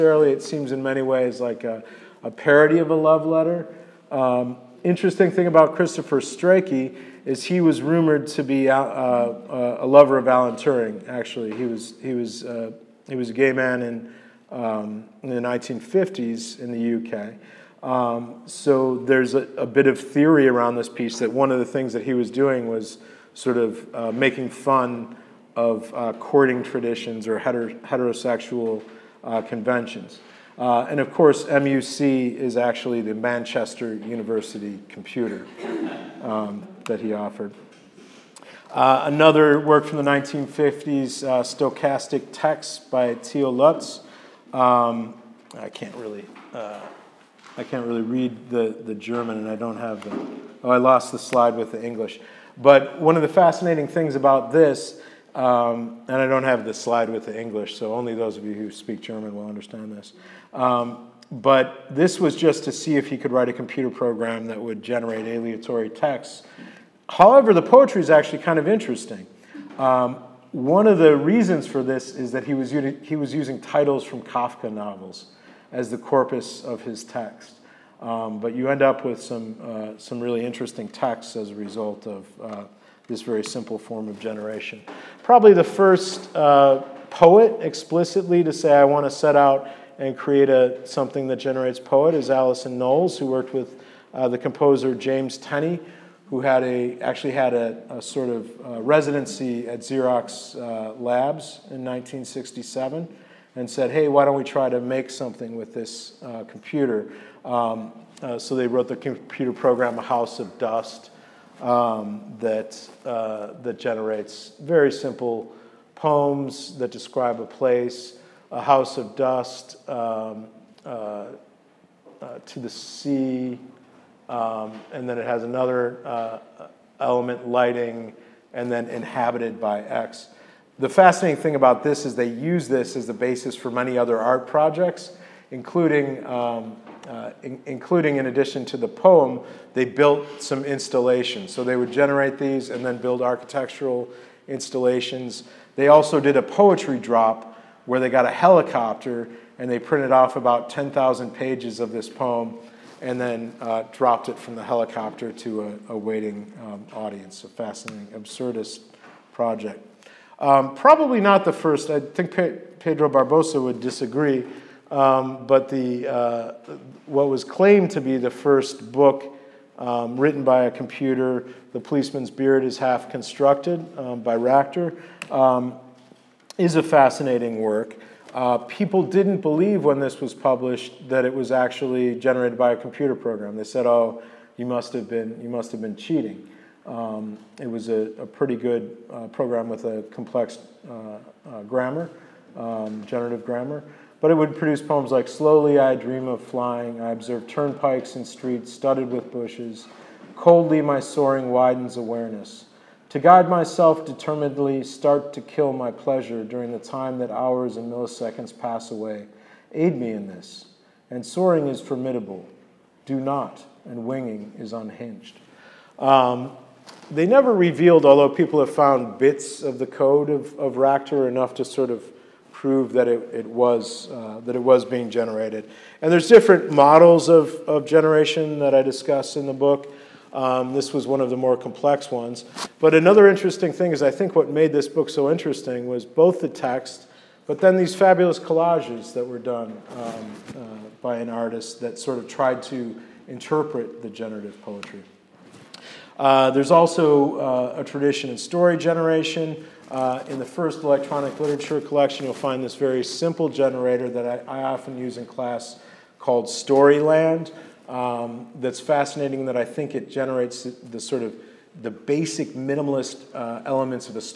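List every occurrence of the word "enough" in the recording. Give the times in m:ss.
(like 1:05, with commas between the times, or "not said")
3:41.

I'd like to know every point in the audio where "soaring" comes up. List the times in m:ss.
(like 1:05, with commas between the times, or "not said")
3:21, 3:31.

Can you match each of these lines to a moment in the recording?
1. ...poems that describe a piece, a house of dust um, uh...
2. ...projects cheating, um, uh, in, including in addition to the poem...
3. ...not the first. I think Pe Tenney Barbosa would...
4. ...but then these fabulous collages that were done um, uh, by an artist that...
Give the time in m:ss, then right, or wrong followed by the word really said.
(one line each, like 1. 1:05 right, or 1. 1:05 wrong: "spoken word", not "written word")
1. 1:55 wrong: "place", not "piece"
2. 2:14 wrong: "including", not "cheating"
3. 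2:41 wrong: "Pedro", not "Tenney"
4. 3:57 right.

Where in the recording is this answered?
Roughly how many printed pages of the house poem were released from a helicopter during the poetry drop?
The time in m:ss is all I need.
2:30.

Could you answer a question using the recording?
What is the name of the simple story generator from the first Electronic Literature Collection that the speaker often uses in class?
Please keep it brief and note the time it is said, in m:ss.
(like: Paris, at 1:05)
Storyland, at 4:16.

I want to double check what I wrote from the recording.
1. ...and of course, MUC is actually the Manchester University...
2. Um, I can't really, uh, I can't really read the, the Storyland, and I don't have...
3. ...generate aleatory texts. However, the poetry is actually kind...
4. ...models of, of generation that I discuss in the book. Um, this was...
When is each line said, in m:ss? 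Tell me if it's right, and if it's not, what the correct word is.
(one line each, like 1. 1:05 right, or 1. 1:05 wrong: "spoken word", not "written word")
1. 0:30 right
2. 0:44 wrong: "German", not "Storyland"
3. 1:04 right
4. 3:46 right.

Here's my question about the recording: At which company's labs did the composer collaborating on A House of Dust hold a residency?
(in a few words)
Xerox.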